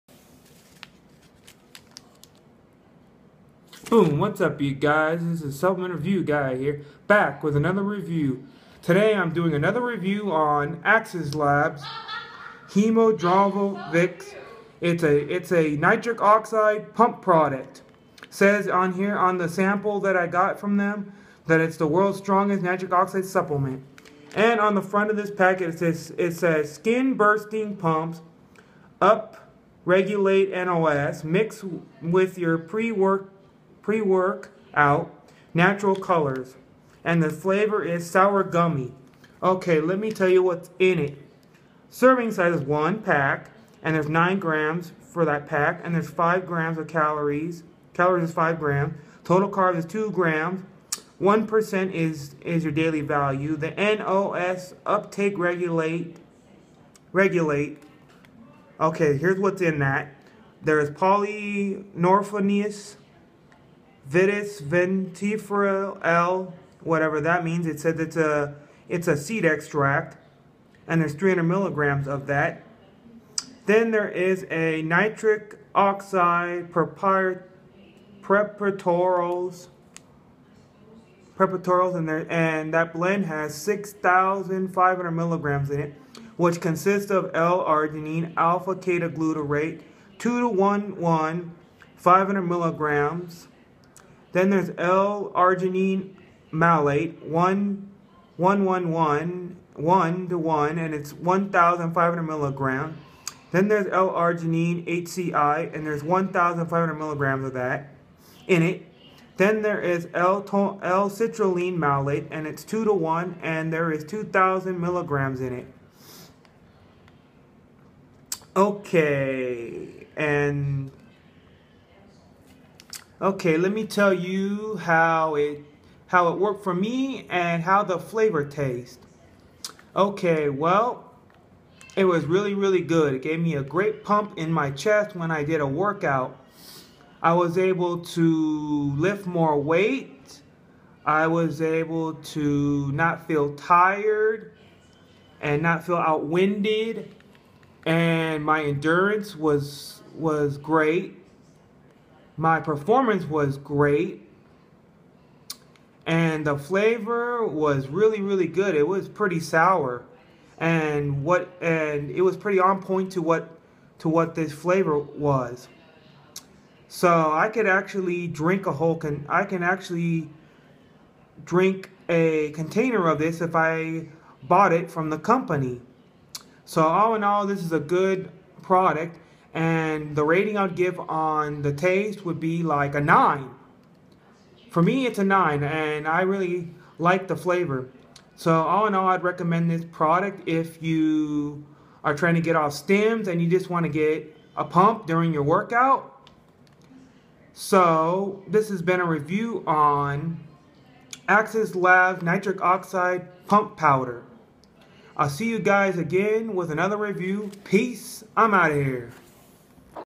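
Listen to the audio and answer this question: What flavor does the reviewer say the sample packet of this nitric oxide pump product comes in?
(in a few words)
sour gummy.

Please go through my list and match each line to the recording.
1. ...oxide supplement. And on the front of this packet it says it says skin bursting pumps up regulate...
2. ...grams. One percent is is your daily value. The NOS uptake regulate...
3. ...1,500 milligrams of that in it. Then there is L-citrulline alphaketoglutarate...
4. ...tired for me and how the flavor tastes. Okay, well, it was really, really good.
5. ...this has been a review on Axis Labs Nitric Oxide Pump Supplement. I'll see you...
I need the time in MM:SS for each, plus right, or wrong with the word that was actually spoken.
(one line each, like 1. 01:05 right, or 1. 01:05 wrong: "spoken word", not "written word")
1. 00:22 right
2. 00:50 right
3. 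01:46 wrong: "malate", not "alphaketoglutarate"
4. 02:06 wrong: "worked", not "tired"
5. 03:18 wrong: "Powder", not "Supplement".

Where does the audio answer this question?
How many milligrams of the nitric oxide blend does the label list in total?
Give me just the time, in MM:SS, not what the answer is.
01:23.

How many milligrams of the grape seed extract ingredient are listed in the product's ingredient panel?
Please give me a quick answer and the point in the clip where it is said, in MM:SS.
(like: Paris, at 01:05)
300 milligrams, at 01:11.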